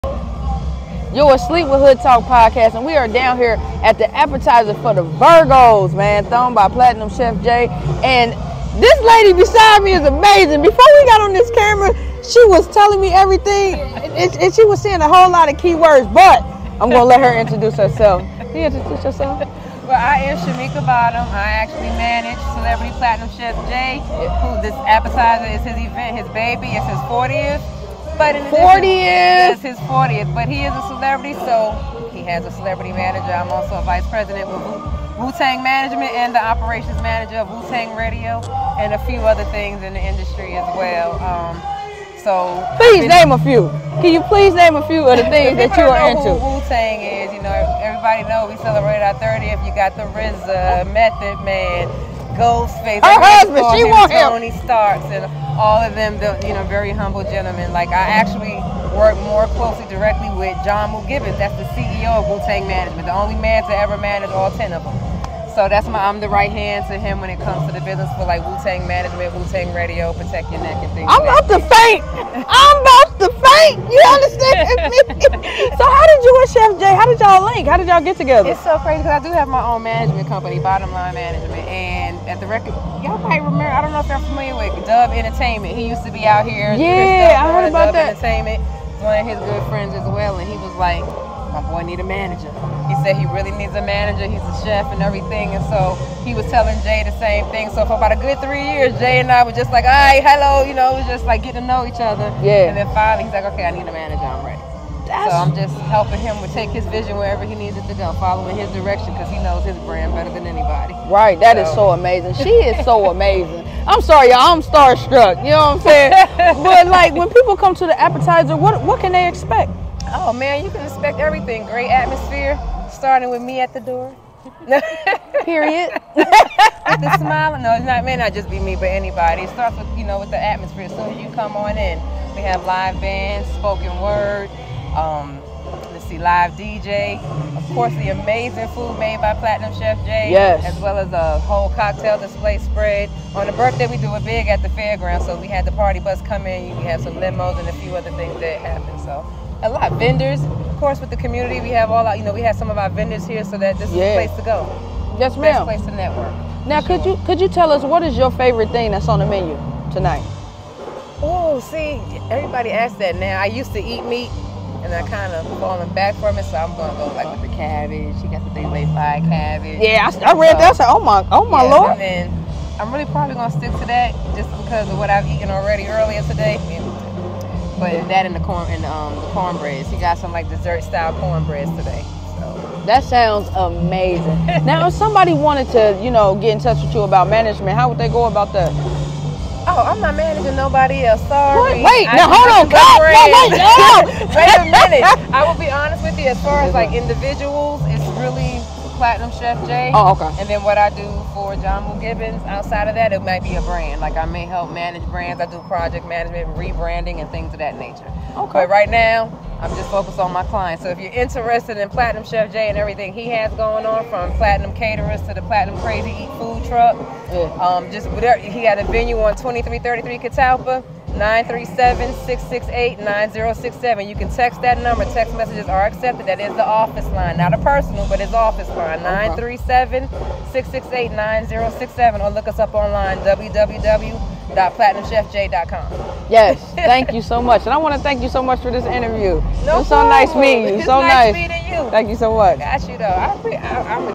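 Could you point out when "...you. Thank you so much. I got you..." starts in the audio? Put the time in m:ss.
4:01.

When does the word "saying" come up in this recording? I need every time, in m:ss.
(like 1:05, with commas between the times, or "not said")
0:14, 1:55.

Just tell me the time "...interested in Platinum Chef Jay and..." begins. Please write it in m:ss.
3:31.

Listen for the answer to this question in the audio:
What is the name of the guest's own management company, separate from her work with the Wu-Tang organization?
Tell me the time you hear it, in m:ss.
1:20.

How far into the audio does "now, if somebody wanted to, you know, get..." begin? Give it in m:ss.
3:04.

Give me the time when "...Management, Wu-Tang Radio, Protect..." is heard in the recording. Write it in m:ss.
1:08.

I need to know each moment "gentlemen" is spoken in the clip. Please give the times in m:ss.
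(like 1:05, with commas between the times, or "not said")
0:57.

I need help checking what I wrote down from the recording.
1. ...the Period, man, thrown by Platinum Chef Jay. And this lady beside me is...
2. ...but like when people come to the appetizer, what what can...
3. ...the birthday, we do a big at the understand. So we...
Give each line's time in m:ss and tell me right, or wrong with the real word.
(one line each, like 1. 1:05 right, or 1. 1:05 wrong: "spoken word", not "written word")
1. 0:04 wrong: "Virgos", not "Period"
2. 1:56 right
3. 2:23 wrong: "fairground", not "understand".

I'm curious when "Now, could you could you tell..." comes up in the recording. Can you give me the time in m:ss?
2:36.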